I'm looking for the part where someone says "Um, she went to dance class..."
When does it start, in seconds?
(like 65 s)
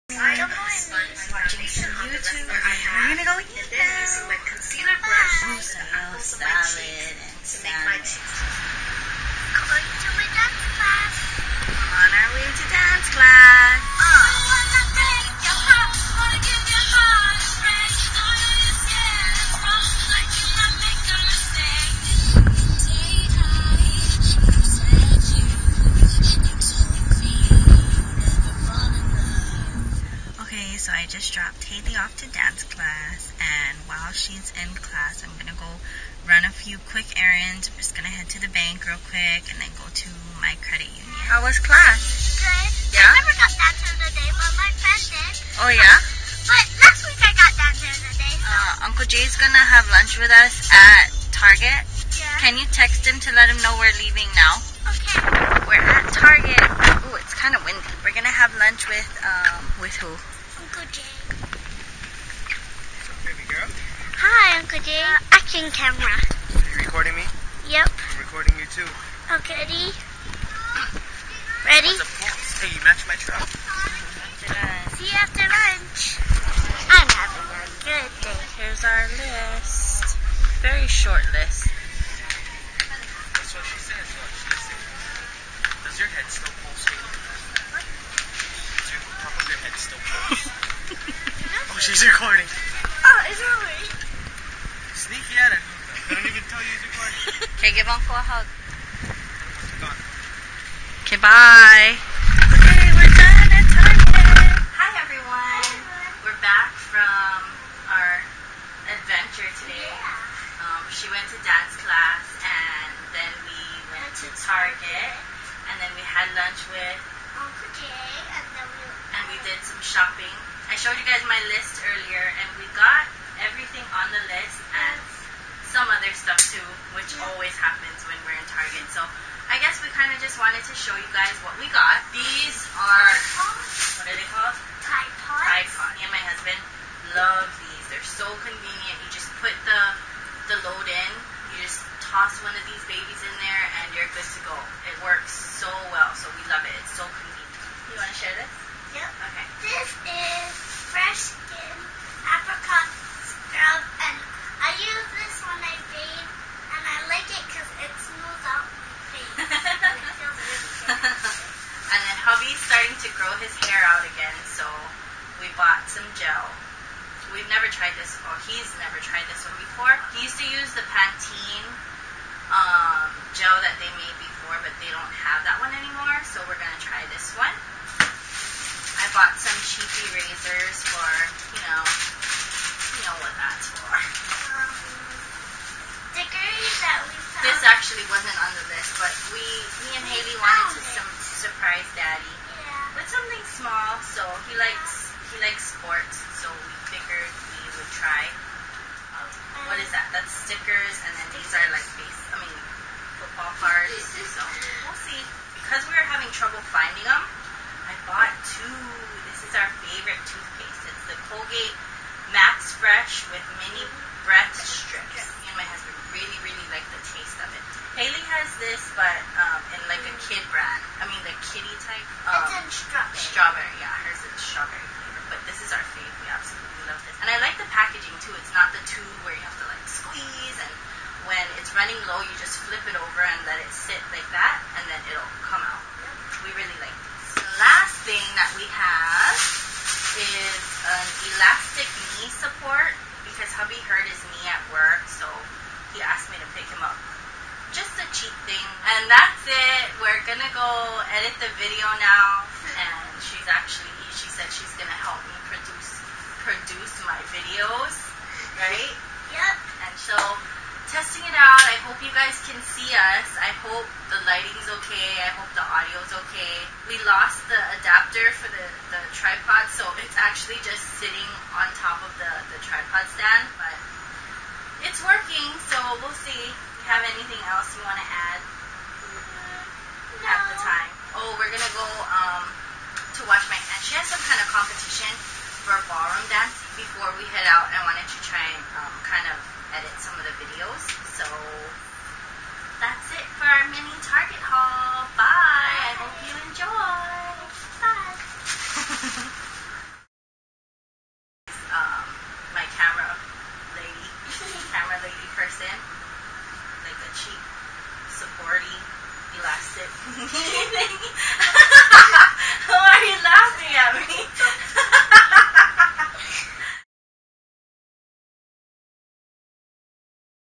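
110 s.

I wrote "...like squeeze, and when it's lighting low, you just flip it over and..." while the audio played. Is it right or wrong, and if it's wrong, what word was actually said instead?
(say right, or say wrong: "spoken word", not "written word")
wrong: "running", not "lighting".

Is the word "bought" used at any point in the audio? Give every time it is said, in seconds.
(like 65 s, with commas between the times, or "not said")
165 s, 179 s, 208 s.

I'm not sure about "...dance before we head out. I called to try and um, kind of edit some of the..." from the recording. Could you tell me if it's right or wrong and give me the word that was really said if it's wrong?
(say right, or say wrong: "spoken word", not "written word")
wrong: "wanted", not "called".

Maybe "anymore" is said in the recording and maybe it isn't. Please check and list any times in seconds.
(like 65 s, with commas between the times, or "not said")
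175 s.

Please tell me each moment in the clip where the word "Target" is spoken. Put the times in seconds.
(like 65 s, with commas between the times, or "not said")
51 s, 56 s, 103 s, 114 s, 128 s, 293 s.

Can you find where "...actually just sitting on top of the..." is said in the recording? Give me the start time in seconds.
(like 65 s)
270 s.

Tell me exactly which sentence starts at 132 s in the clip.
These are, what are they called?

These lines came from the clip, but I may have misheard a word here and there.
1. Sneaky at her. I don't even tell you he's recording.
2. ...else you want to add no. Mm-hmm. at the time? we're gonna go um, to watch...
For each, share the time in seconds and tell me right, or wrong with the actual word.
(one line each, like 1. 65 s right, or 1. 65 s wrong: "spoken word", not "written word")
1. 94 s right
2. 277 s right.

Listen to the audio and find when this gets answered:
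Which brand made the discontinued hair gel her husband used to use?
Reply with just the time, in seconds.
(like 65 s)
170 s.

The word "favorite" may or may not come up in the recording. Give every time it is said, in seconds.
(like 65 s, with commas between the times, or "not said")
209 s, 225 s.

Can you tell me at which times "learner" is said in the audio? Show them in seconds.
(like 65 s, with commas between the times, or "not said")
not said.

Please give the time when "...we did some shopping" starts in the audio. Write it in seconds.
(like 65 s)
119 s.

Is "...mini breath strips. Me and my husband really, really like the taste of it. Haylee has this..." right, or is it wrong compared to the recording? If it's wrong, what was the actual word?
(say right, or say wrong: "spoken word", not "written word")
right.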